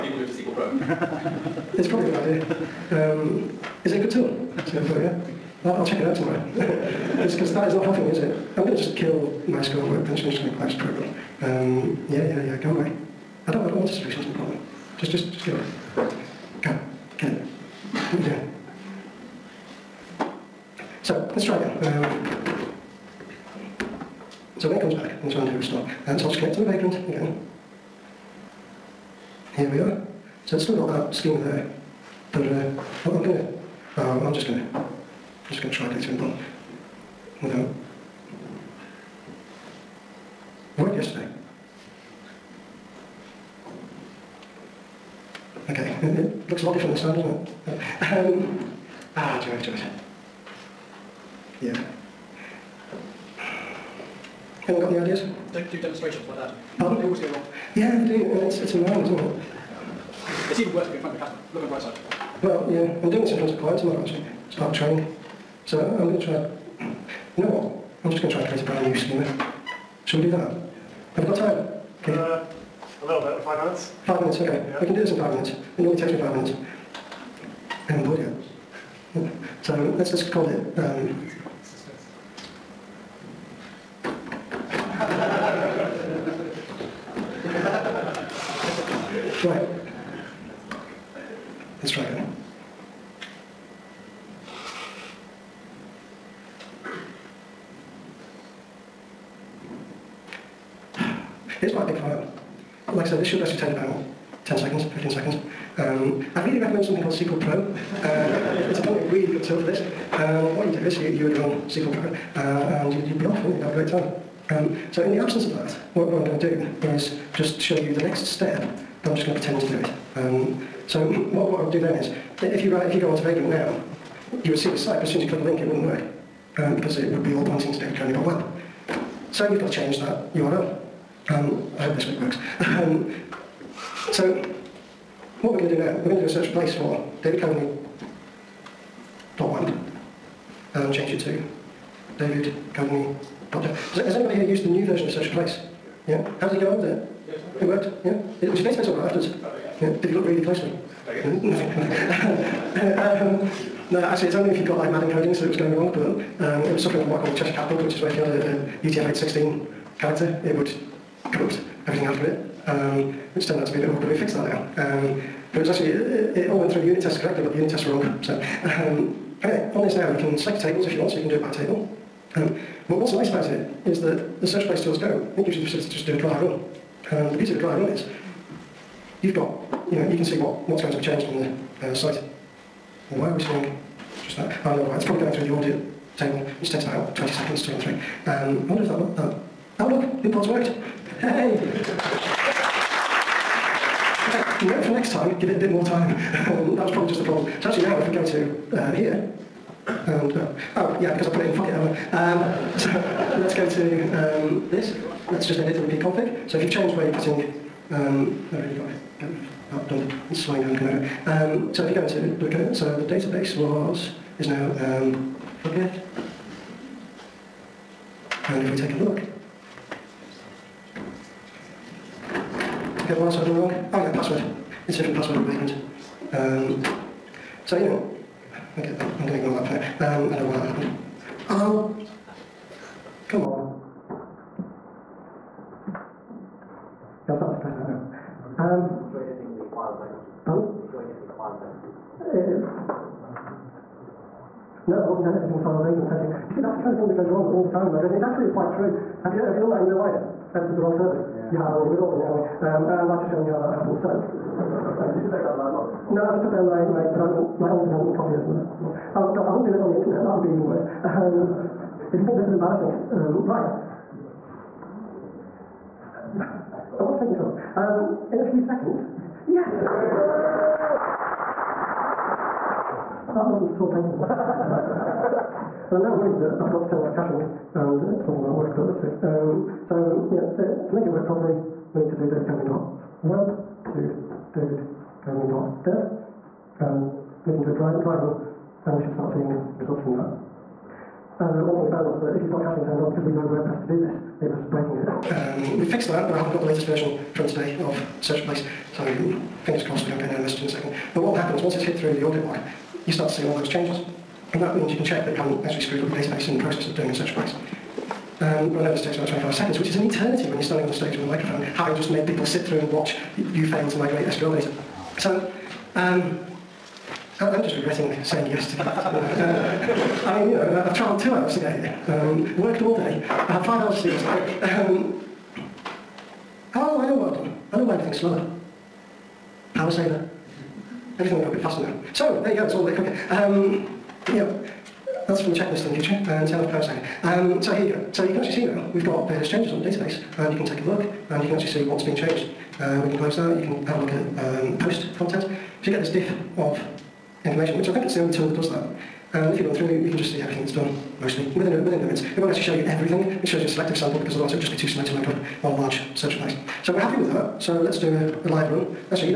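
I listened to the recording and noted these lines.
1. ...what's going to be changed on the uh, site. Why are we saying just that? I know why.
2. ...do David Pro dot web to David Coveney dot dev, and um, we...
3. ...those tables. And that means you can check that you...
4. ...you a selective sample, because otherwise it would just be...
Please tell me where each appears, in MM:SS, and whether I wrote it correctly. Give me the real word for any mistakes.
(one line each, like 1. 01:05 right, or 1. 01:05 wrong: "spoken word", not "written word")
1. 03:00 wrong: "seeing", not "saying"
2. 04:42 wrong: "Coveney", not "Pro"
3. 05:03 wrong: "changes", not "tables"
4. 05:53 right.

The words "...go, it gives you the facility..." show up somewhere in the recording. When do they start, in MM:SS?
02:54.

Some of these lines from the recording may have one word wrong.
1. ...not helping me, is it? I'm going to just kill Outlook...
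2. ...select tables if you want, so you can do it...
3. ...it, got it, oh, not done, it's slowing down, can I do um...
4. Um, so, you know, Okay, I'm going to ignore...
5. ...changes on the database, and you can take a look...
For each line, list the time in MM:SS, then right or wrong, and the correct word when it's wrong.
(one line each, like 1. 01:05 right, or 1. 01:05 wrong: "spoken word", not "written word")
1. 00:07 wrong: "MySQL", not "Outlook"
2. 02:50 right
3. 03:28 right
4. 03:46 right
5. 05:39 right.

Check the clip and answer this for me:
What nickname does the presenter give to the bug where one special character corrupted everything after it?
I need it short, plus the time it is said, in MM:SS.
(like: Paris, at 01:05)
Cheshire Cat bug, at 02:37.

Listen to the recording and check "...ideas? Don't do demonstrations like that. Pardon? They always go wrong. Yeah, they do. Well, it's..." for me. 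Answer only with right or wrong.
right.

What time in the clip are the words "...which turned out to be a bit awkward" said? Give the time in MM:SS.
02:43.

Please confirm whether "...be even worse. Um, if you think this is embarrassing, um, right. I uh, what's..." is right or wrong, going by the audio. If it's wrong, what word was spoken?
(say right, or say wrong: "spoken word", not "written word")
right.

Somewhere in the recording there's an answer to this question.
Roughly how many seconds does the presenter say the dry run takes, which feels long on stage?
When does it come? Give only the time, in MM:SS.
05:09.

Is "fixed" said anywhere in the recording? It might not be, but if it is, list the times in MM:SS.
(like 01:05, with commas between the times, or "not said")
02:44, 04:55.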